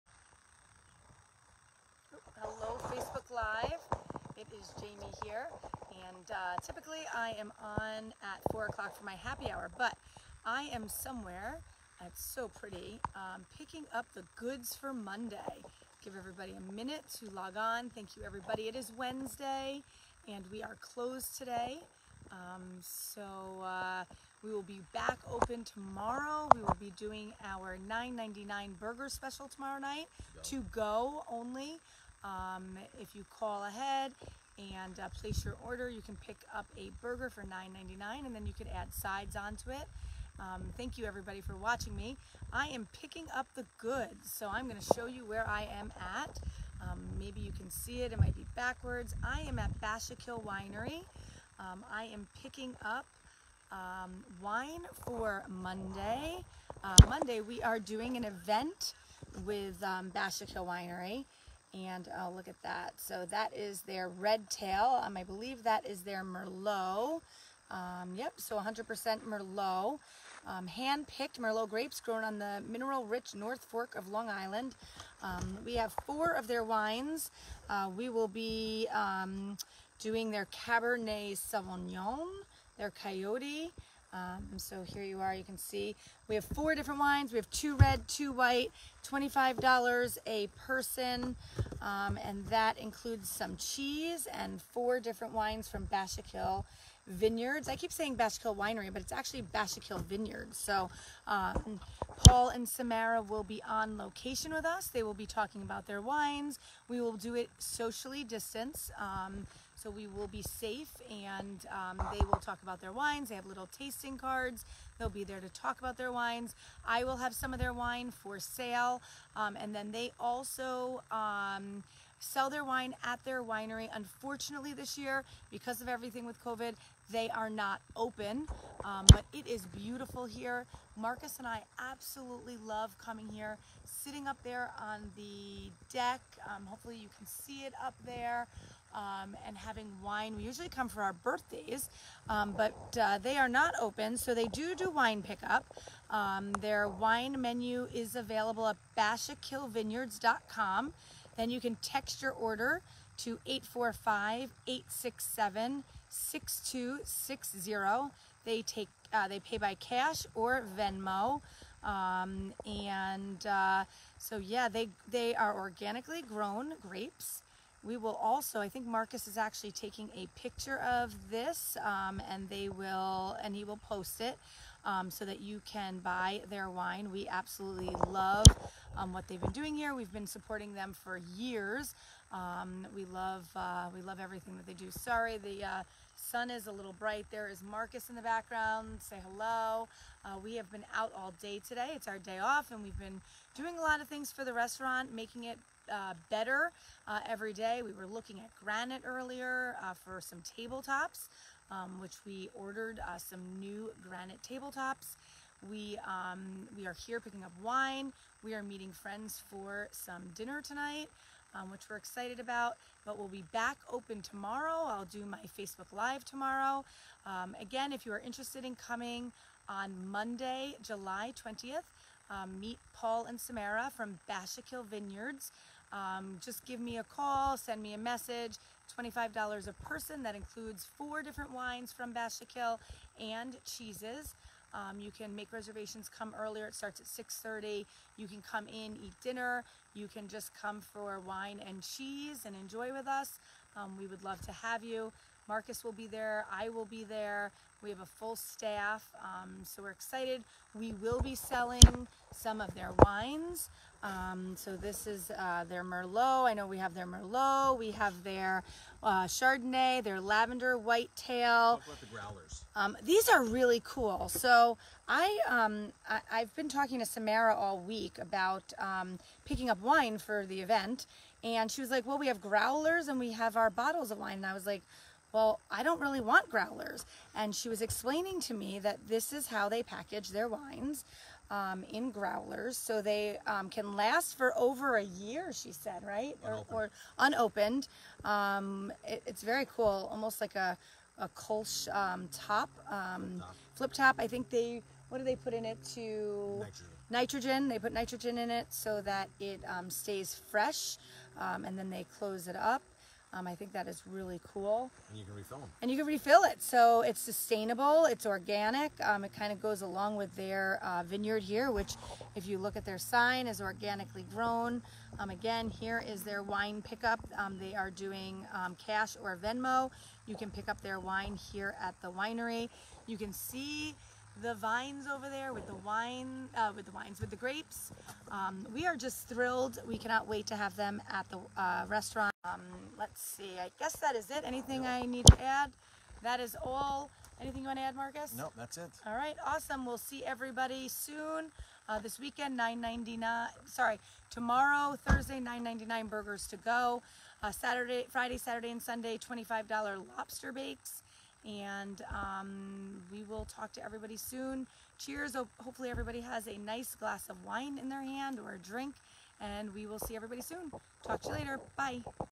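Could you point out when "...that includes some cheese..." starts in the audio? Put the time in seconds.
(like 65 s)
92 s.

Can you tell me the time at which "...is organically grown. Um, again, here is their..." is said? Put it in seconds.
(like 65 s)
313 s.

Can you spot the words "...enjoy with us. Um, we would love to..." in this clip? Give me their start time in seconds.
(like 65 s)
242 s.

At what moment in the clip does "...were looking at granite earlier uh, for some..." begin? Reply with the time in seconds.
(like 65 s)
197 s.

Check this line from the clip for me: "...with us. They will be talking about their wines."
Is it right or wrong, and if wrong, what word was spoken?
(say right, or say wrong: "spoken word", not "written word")
right.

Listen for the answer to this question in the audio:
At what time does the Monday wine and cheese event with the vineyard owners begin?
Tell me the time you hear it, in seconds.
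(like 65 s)
237 s.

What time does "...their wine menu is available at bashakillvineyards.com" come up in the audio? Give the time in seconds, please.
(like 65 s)
146 s.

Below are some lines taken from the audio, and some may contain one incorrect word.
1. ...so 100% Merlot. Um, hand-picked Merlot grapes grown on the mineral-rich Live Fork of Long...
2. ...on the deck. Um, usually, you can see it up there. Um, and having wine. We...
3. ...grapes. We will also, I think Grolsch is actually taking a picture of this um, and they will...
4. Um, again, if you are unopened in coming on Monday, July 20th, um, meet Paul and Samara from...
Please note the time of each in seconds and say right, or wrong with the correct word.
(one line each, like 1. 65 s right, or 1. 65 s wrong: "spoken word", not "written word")
1. 68 s wrong: "North", not "Live"
2. 134 s wrong: "hopefully", not "usually"
3. 166 s wrong: "Marcus", not "Grolsch"
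4. 217 s wrong: "interested", not "unopened".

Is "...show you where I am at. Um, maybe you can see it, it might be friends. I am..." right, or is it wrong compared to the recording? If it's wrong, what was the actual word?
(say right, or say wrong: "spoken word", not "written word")
wrong: "backwards", not "friends".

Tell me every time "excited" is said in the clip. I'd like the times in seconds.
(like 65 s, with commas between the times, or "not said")
211 s, 249 s.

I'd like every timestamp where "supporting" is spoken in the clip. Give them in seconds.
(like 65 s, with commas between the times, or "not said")
180 s.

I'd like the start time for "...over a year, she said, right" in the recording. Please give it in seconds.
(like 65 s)
284 s.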